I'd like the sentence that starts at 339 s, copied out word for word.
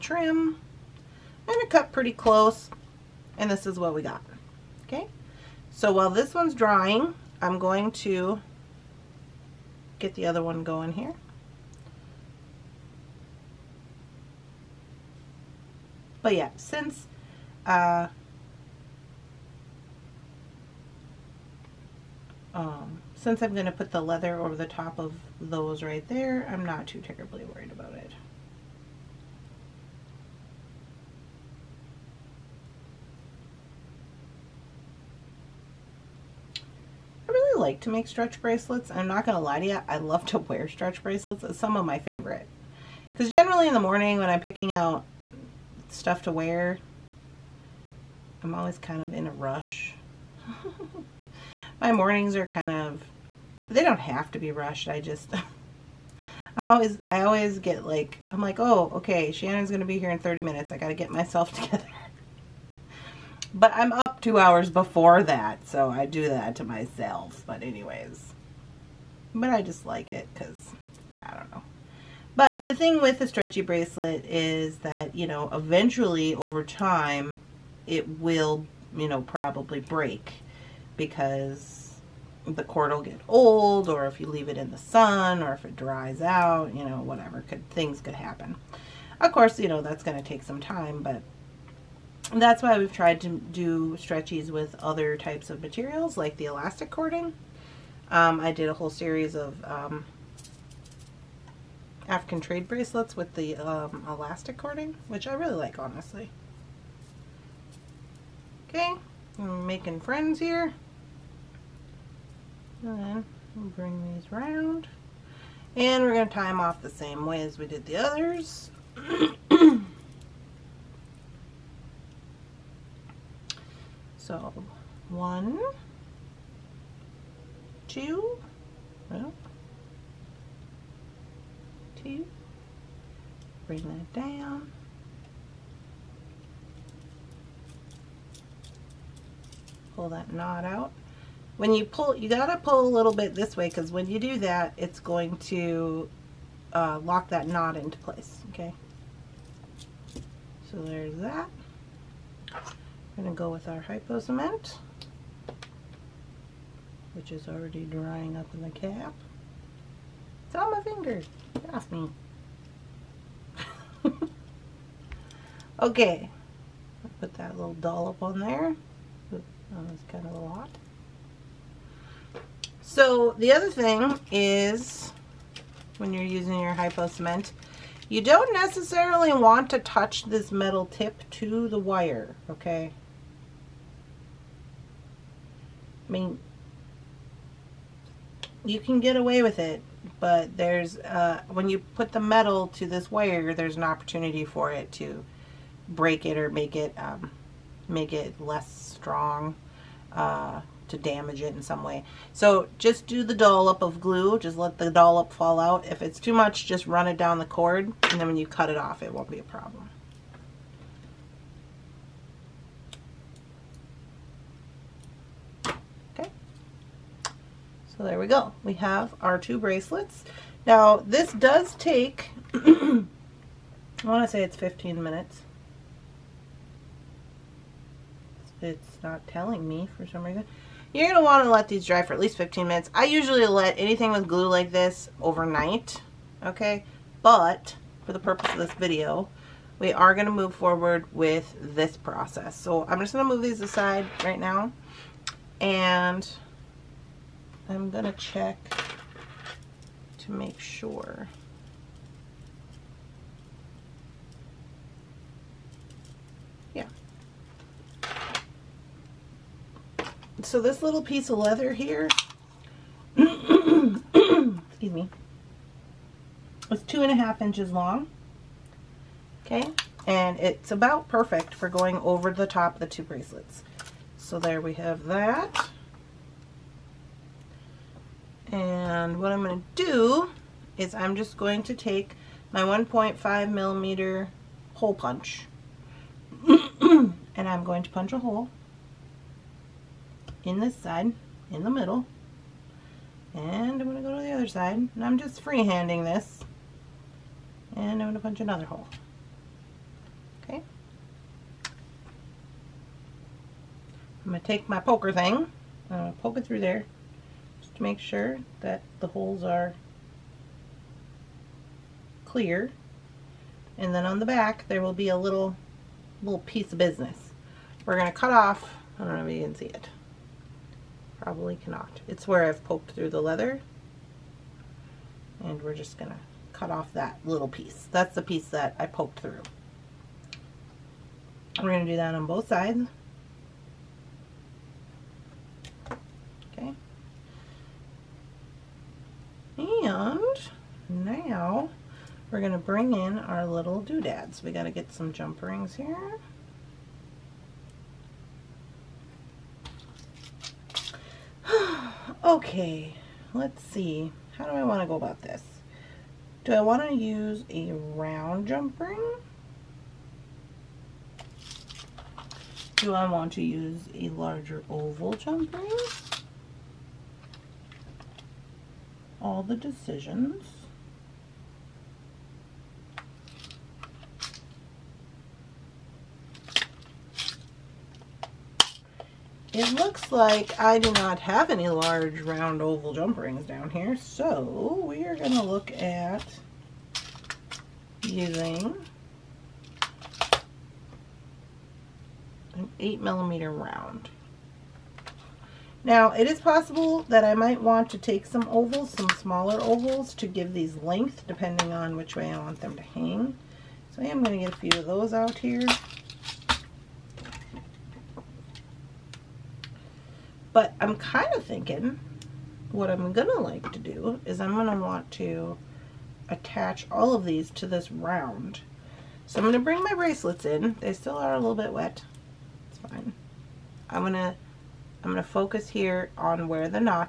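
And now we're going to bring in our little doodads.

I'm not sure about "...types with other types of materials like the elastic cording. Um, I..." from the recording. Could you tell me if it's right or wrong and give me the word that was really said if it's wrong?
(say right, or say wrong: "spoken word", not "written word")
wrong: "stretchies", not "types".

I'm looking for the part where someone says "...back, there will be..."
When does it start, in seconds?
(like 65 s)
314 s.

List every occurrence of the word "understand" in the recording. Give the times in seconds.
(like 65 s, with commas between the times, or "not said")
not said.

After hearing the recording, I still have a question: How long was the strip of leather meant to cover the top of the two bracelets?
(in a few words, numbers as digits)
2.5 inches.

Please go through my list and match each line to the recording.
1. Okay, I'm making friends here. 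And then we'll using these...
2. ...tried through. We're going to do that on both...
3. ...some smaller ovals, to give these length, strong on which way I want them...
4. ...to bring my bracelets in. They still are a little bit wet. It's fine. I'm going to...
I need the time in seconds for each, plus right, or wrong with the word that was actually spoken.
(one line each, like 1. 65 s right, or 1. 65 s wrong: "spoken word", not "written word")
1. 108 s wrong: "bring", not "using"
2. 328 s wrong: "poked", not "tried"
3. 398 s wrong: "depending", not "strong"
4. 419 s right.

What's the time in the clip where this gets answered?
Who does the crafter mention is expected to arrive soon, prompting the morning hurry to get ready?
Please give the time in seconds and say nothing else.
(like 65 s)
59 s.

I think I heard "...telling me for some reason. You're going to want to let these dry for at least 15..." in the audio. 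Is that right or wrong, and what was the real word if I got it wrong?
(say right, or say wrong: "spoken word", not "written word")
right.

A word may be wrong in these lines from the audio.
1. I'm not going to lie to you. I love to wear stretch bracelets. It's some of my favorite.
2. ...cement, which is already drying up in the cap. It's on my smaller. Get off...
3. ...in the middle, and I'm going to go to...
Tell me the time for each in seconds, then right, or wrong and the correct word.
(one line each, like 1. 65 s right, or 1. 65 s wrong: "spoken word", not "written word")
1. 38 s right
2. 154 s wrong: "finger", not "smaller"
3. 291 s right.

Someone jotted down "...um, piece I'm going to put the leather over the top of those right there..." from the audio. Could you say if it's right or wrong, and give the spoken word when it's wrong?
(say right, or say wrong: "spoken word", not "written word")
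wrong: "since", not "piece".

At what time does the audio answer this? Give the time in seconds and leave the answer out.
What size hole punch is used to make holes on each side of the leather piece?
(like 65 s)
282 s.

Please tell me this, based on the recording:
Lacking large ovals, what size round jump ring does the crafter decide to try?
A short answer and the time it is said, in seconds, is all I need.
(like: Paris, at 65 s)
8 millimeter, at 392 s.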